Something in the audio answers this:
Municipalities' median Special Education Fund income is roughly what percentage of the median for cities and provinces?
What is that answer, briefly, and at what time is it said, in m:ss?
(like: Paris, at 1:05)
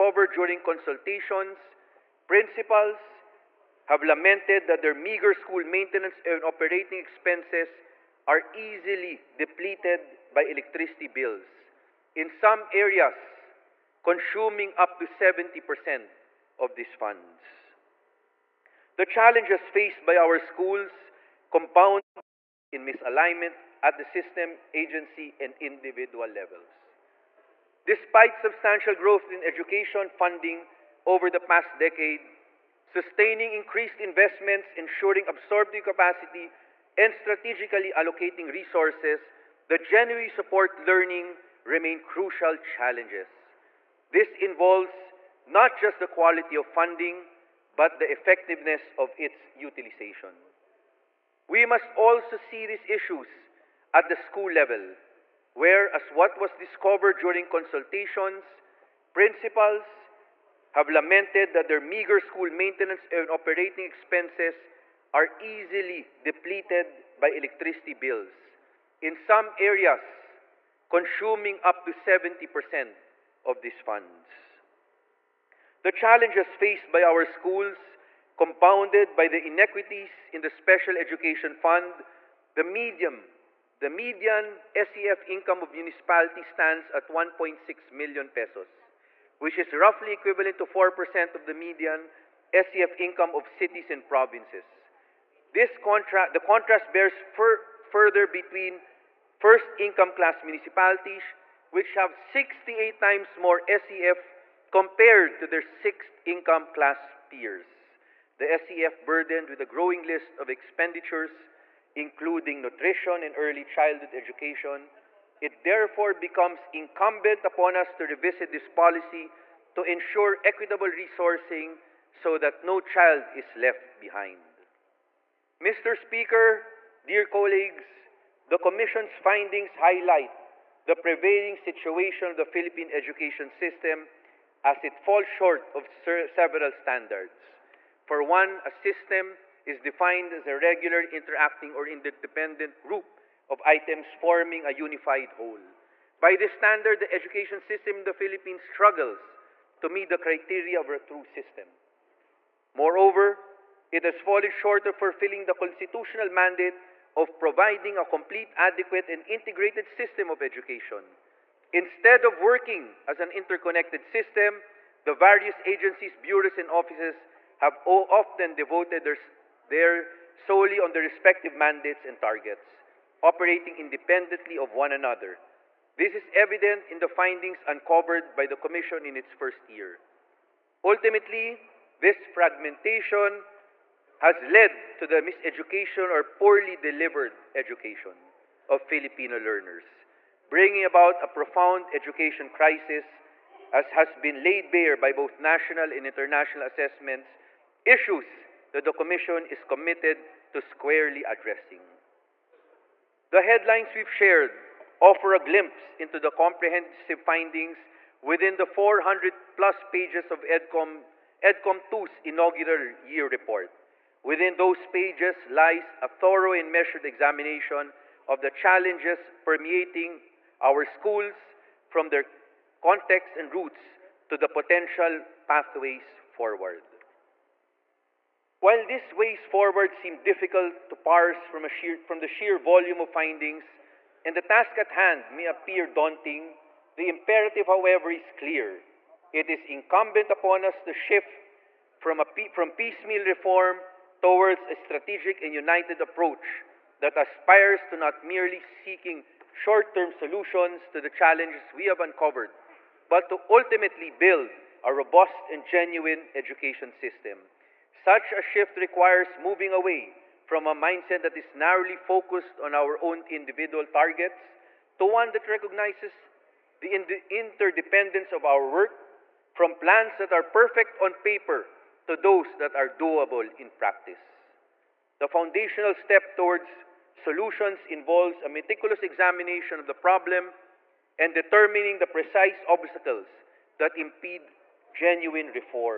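4%, at 1:30.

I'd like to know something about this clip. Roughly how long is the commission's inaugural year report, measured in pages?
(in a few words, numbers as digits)
400 plus pages.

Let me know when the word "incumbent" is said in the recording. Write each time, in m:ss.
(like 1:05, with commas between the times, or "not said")
1:56, 3:59.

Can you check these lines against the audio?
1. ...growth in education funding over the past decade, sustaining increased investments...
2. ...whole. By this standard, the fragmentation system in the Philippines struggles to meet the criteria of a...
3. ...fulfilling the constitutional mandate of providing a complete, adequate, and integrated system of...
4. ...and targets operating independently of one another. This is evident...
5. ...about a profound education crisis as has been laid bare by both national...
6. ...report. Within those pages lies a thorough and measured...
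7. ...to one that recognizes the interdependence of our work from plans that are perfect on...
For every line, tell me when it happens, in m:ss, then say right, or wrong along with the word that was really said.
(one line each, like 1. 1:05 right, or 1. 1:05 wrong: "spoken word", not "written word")
1. 0:28 right
2. 2:25 wrong: "education", not "fragmentation"
3. 2:34 right
4. 2:52 right
5. 3:10 right
6. 3:33 right
7. 4:24 right.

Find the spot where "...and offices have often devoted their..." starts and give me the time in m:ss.
2:46.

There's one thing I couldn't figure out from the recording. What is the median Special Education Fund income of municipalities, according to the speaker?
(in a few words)
1.6 million pesos.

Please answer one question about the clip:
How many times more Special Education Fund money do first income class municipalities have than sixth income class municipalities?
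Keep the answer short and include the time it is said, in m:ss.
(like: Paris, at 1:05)
68 times, at 1:42.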